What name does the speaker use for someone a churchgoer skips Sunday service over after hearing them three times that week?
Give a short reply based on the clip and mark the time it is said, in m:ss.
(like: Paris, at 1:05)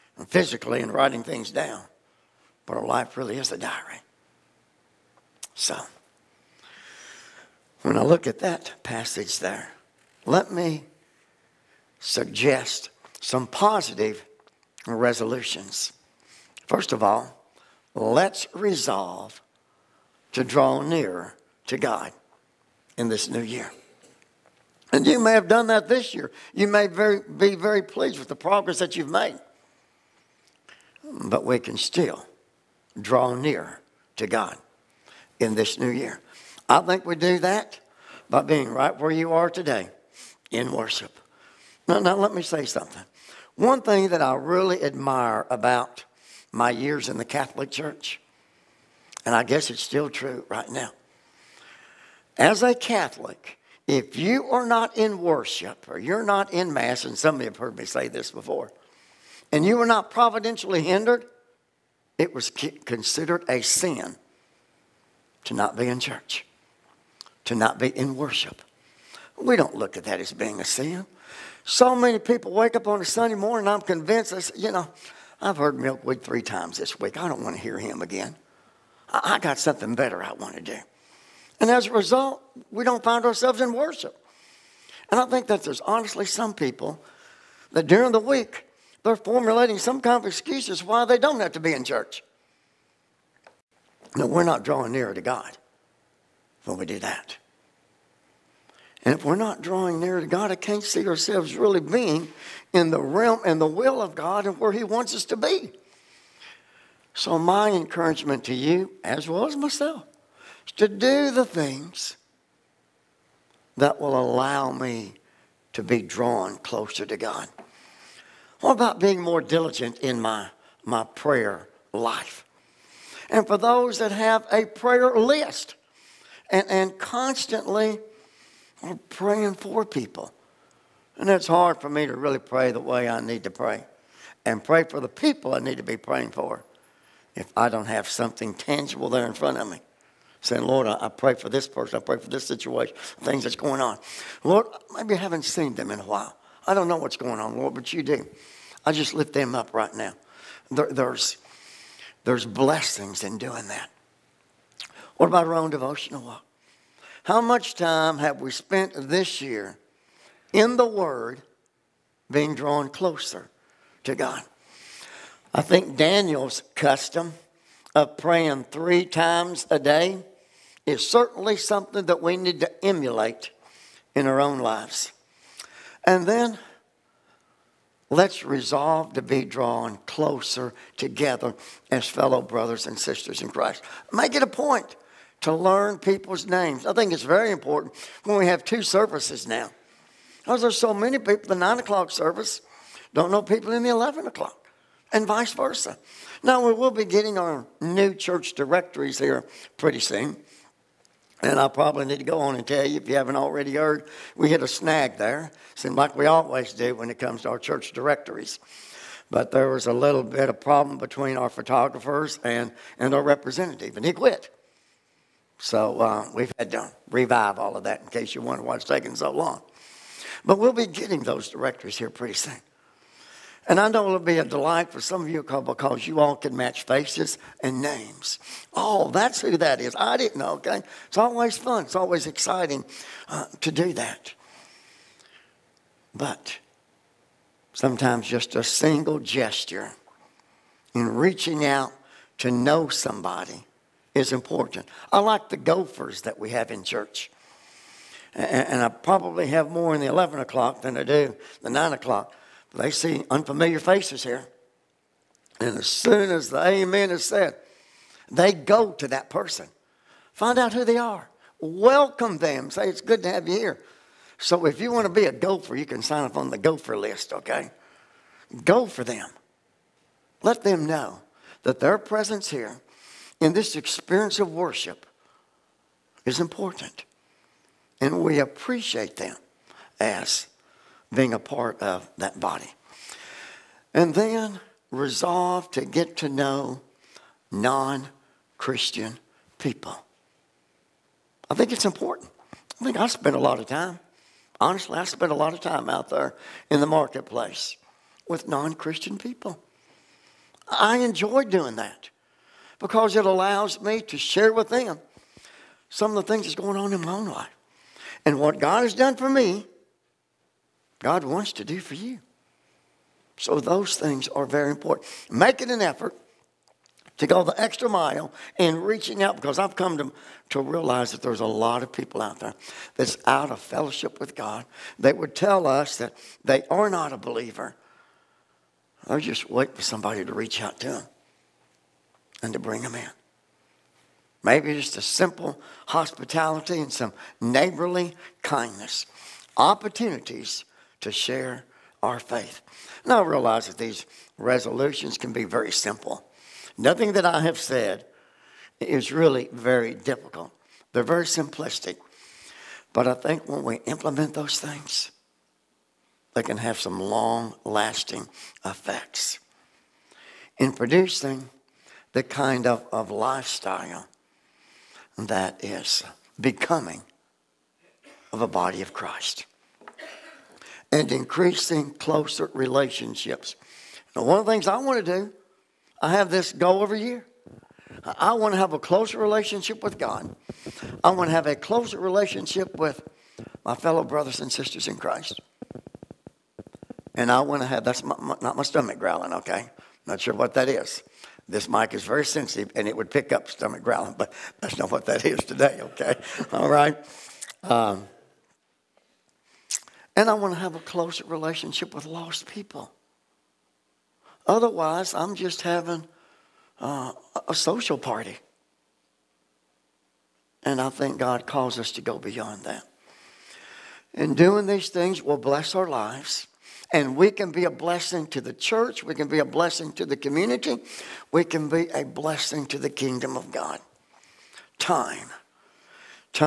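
Milkweed, at 1:15.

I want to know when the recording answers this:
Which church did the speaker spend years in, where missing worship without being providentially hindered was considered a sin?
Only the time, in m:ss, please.
0:47.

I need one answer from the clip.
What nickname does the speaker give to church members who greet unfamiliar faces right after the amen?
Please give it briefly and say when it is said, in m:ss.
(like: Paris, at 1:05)
gophers, at 4:05.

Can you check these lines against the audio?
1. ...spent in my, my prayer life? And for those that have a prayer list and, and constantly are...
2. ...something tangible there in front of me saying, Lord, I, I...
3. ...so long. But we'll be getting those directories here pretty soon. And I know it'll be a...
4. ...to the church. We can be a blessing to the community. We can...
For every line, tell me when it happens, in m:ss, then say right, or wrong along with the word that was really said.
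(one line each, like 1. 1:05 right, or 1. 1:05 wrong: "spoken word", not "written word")
1. 1:59 wrong: "diligent", not "spent"
2. 2:18 right
3. 3:39 right
4. 6:58 right.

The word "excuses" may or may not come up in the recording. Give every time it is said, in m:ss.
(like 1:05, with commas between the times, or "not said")
1:30.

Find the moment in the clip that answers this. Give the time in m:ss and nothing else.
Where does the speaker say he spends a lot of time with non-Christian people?
4:56.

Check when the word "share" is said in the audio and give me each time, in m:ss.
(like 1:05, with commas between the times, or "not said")
5:04, 5:41.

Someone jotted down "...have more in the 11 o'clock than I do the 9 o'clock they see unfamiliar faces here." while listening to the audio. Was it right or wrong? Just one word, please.
right.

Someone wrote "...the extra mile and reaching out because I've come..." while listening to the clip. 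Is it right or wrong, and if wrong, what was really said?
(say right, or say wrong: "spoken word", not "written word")
right.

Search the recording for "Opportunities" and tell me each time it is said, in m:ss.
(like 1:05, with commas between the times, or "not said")
5:39.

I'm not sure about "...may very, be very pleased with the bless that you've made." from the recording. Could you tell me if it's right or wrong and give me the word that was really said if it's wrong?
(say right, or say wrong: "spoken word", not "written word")
wrong: "progress", not "bless".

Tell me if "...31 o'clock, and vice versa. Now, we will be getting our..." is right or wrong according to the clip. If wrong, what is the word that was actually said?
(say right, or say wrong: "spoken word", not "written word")
wrong: "11", not "31".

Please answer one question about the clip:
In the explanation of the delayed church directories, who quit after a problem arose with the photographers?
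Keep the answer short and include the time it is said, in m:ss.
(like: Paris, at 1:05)
our representative, at 3:33.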